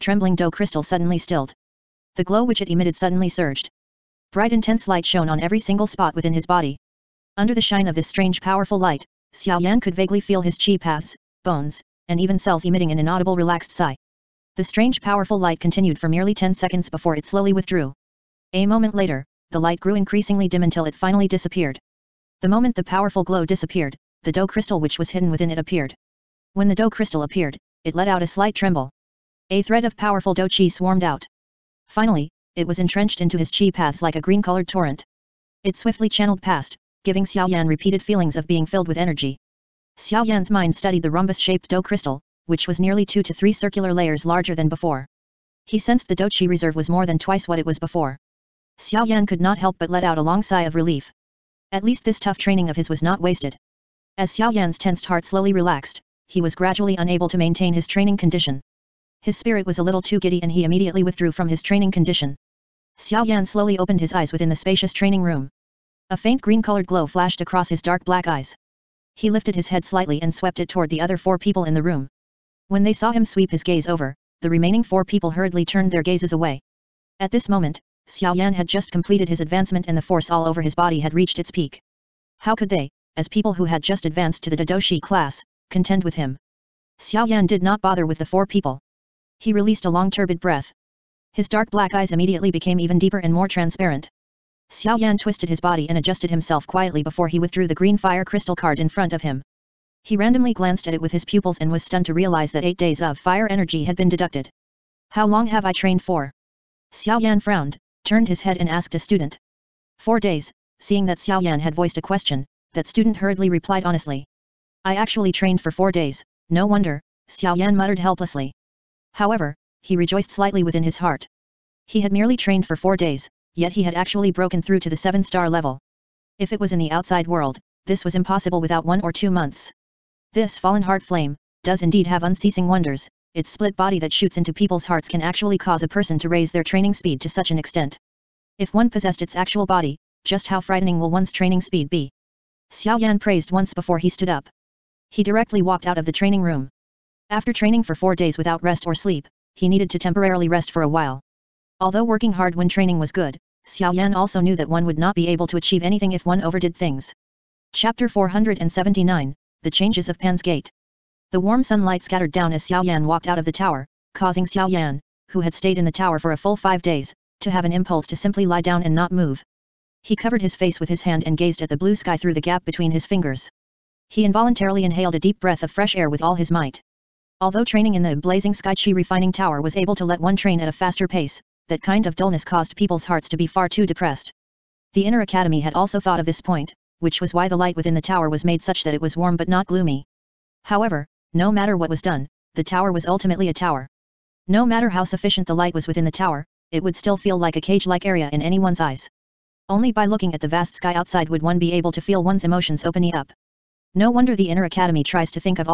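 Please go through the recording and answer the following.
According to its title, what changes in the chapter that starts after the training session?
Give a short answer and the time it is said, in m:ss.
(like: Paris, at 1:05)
Pan's gate, at 2:40.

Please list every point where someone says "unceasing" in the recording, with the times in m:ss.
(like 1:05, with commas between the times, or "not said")
2:12.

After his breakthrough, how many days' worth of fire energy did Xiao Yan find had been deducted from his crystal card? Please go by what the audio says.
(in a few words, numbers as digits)
8.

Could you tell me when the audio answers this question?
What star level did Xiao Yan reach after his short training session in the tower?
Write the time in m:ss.
2:04.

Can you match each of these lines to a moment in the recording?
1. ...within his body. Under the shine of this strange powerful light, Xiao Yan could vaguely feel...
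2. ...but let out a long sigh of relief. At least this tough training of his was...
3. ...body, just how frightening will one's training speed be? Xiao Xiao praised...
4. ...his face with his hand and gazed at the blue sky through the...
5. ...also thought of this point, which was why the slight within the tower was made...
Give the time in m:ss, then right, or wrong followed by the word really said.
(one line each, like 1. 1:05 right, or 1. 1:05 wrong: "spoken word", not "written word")
1. 0:06 right
2. 0:49 right
3. 2:19 wrong: "Yan", not "Xiao"
4. 2:50 right
5. 3:05 wrong: "light", not "slight".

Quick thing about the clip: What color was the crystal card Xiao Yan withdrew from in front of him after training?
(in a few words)
green.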